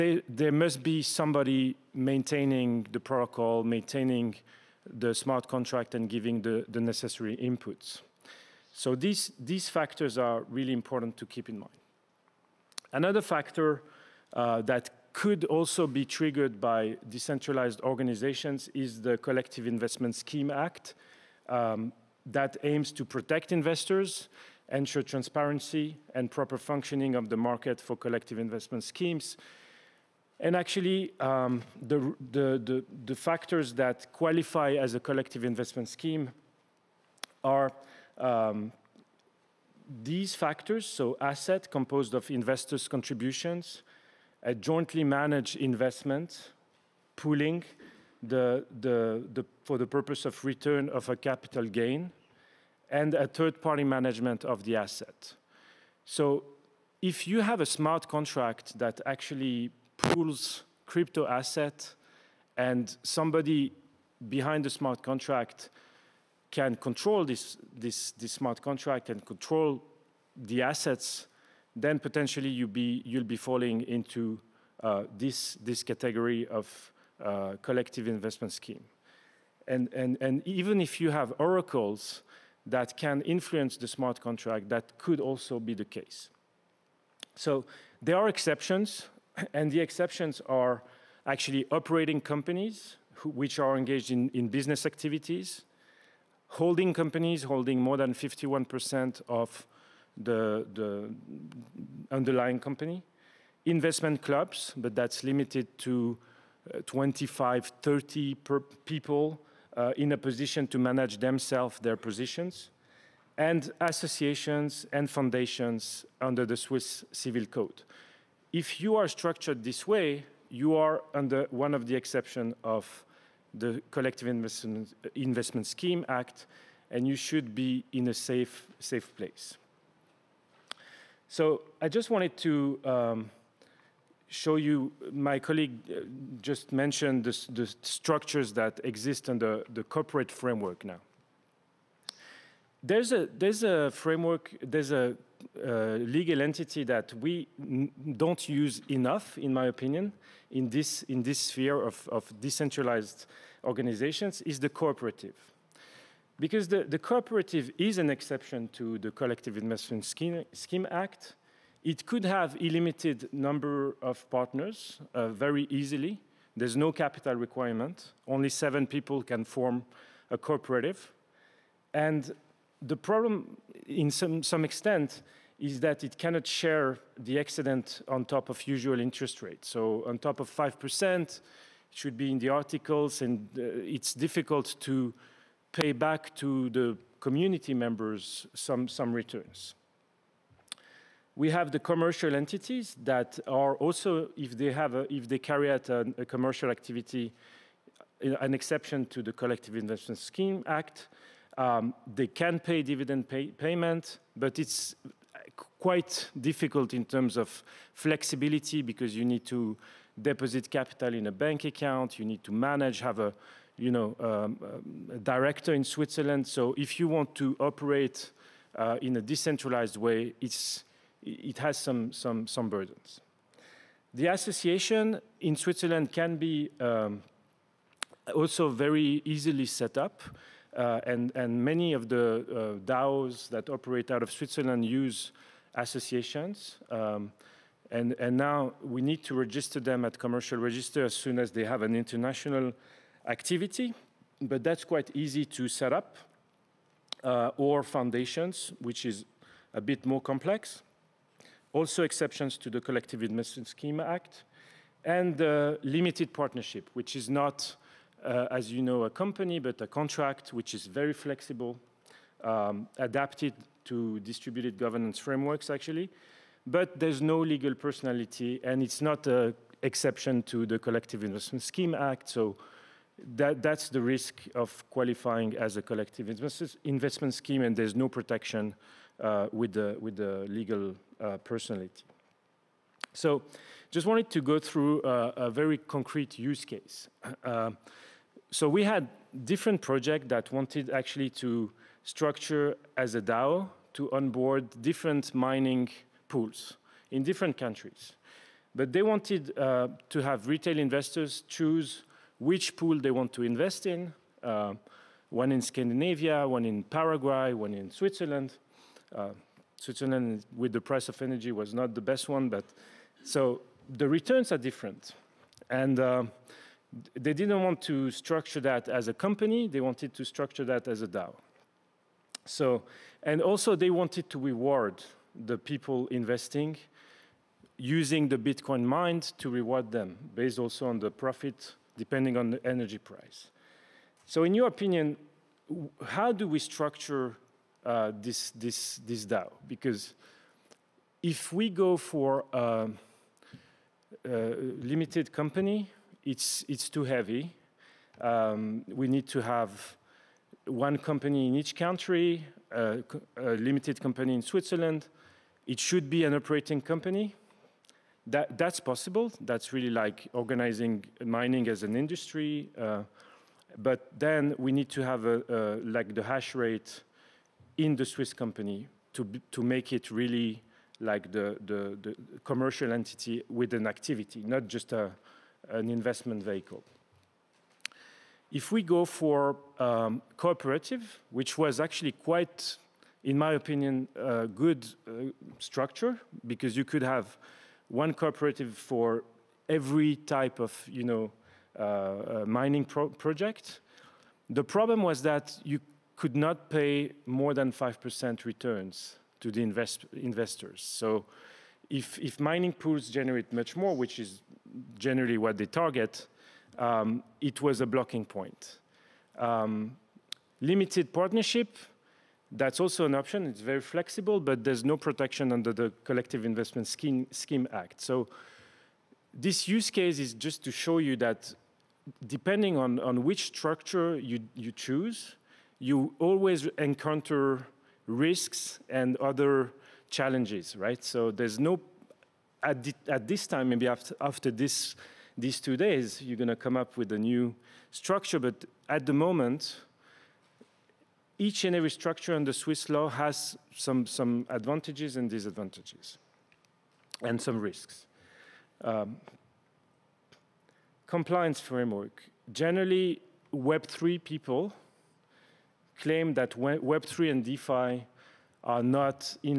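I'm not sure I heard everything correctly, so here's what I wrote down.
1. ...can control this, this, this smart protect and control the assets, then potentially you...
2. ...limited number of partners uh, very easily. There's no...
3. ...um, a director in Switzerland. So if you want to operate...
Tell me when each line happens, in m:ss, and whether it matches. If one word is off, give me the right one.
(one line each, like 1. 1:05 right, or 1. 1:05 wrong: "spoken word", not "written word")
1. 1:06 wrong: "contract", not "protect"
2. 2:42 right
3. 3:34 right.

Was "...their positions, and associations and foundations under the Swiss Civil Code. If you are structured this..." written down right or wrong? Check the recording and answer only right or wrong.
right.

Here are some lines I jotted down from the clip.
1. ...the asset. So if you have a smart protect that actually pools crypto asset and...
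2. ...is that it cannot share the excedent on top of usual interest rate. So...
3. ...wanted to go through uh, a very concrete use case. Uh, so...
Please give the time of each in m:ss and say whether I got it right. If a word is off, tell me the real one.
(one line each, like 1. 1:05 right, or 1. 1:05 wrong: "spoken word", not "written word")
1. 0:54 wrong: "contract", not "protect"
2. 2:55 right
3. 4:44 right.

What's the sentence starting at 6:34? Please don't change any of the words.
The problem was that you could not pay more than 5% returns to the invest investors.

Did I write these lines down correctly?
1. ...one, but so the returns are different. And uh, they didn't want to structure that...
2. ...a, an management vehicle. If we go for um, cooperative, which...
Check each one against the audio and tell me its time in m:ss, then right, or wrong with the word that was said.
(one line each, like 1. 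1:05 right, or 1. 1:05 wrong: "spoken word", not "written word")
1. 5:12 right
2. 6:14 wrong: "investment", not "management".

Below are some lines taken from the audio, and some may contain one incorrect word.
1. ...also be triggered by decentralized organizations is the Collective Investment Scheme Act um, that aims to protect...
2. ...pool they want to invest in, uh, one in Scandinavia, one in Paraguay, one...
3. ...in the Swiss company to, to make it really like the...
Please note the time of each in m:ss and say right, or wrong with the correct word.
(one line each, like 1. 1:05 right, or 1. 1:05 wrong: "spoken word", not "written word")
1. 0:15 right
2. 5:02 right
3. 6:07 right.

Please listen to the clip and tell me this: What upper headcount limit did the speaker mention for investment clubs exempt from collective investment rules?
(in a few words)
30 people.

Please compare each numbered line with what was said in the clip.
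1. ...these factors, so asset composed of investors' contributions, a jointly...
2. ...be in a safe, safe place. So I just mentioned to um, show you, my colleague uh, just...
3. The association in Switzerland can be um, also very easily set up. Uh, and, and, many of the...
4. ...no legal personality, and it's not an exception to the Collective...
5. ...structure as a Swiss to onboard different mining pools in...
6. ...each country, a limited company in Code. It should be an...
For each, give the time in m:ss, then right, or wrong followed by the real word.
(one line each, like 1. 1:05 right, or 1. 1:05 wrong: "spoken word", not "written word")
1. 0:40 right
2. 2:07 wrong: "wanted", not "mentioned"
3. 3:44 right
4. 4:27 right
5. 4:52 wrong: "DAO", not "Swiss"
6. 5:51 wrong: "Switzerland", not "Code".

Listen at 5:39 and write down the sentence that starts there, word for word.
Because if we go for a, um, a uh, limited company, it's, it's too heavy.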